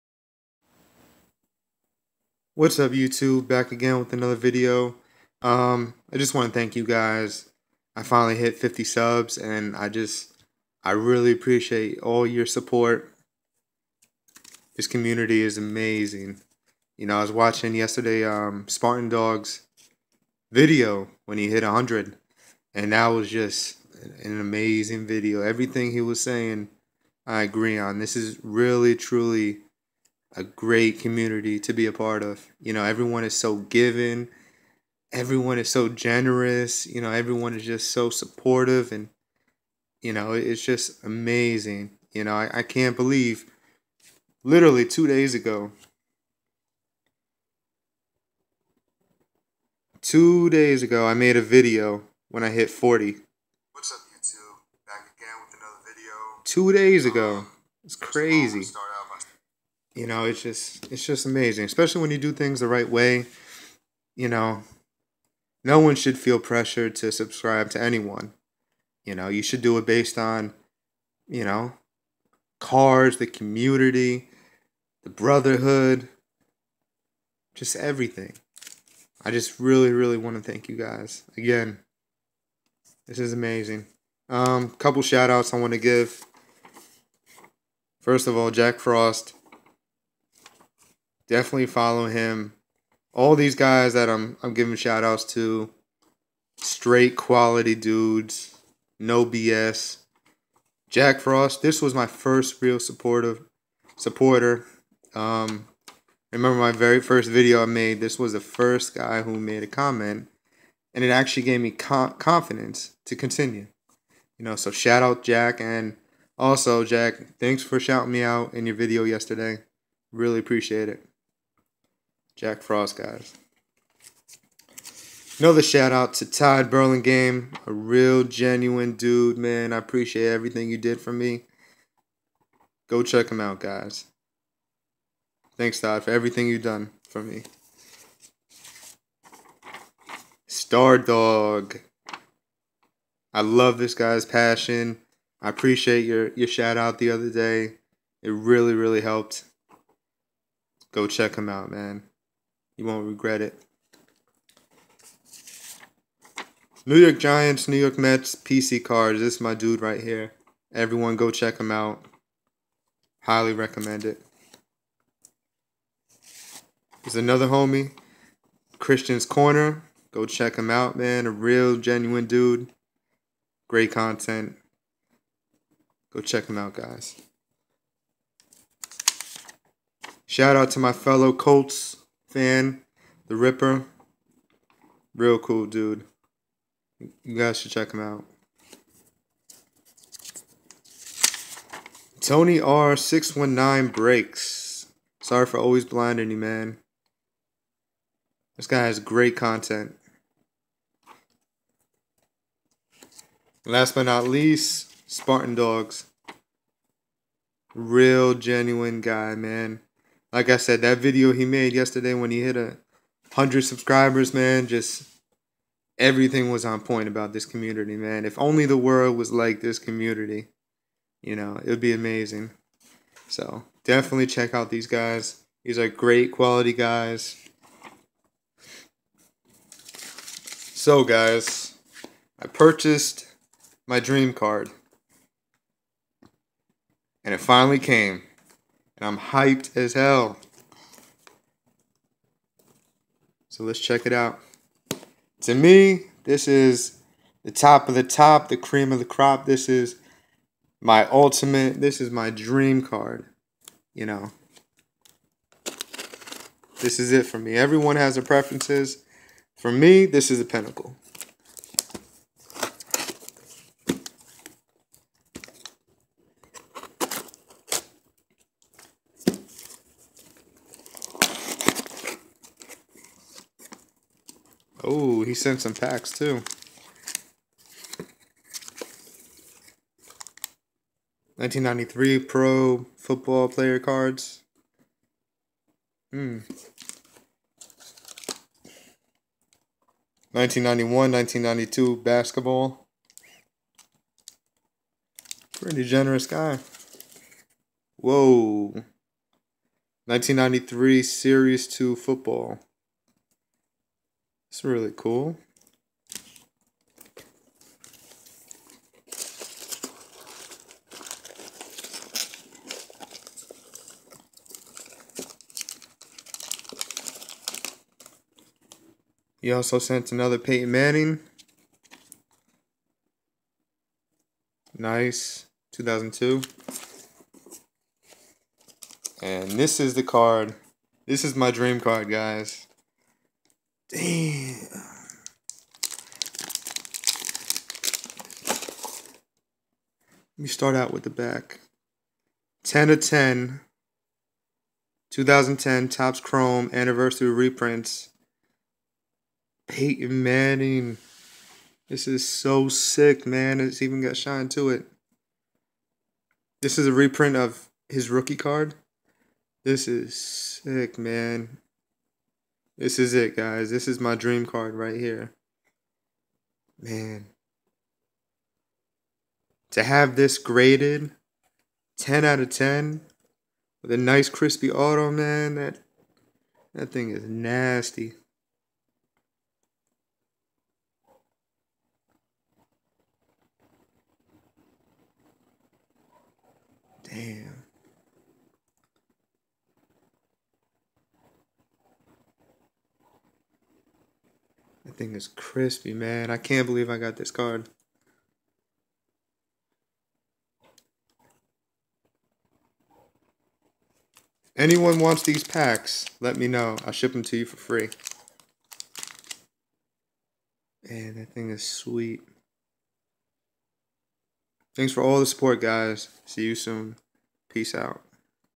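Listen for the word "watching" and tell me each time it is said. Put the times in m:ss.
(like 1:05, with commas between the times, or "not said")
0:17.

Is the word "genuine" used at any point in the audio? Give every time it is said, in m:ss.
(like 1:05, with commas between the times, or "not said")
2:08, 2:51, 3:28.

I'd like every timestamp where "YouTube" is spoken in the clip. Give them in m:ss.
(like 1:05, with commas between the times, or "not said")
0:02, 0:54.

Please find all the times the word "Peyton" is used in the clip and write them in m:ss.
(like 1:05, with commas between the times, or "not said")
5:20, 5:49.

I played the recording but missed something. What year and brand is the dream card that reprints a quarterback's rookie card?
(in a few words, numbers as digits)
2010 Topps Chrome.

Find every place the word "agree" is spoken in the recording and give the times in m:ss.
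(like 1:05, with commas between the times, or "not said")
0:27.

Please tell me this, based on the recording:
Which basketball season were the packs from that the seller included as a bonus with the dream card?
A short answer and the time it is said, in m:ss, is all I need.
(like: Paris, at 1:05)
1991-1992, at 4:50.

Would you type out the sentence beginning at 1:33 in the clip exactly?
All these guys that I'm I'm giving shout outs to.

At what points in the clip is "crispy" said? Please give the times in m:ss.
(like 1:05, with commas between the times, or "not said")
6:14, 6:35.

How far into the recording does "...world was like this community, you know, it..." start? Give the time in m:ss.
3:38.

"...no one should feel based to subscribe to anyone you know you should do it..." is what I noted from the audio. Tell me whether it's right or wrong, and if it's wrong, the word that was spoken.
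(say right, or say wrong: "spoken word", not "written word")
wrong: "pressured", not "based".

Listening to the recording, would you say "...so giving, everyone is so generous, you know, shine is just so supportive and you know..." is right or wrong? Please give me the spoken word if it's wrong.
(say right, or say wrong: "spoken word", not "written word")
wrong: "everyone", not "shine".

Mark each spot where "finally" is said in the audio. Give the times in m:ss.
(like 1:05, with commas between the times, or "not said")
0:08, 3:57.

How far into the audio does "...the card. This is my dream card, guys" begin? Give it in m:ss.
5:29.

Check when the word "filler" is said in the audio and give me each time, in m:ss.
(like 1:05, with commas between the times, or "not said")
not said.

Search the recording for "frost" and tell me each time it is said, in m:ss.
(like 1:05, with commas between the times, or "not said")
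1:28, 1:41, 2:02.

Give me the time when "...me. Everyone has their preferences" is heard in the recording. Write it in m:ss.
4:17.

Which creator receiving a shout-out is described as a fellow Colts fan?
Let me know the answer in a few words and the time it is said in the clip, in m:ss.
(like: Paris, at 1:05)
the Ripper, at 3:03.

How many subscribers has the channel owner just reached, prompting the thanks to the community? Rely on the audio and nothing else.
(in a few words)
50.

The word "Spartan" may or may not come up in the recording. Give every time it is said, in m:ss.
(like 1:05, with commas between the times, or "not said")
0:18, 3:25.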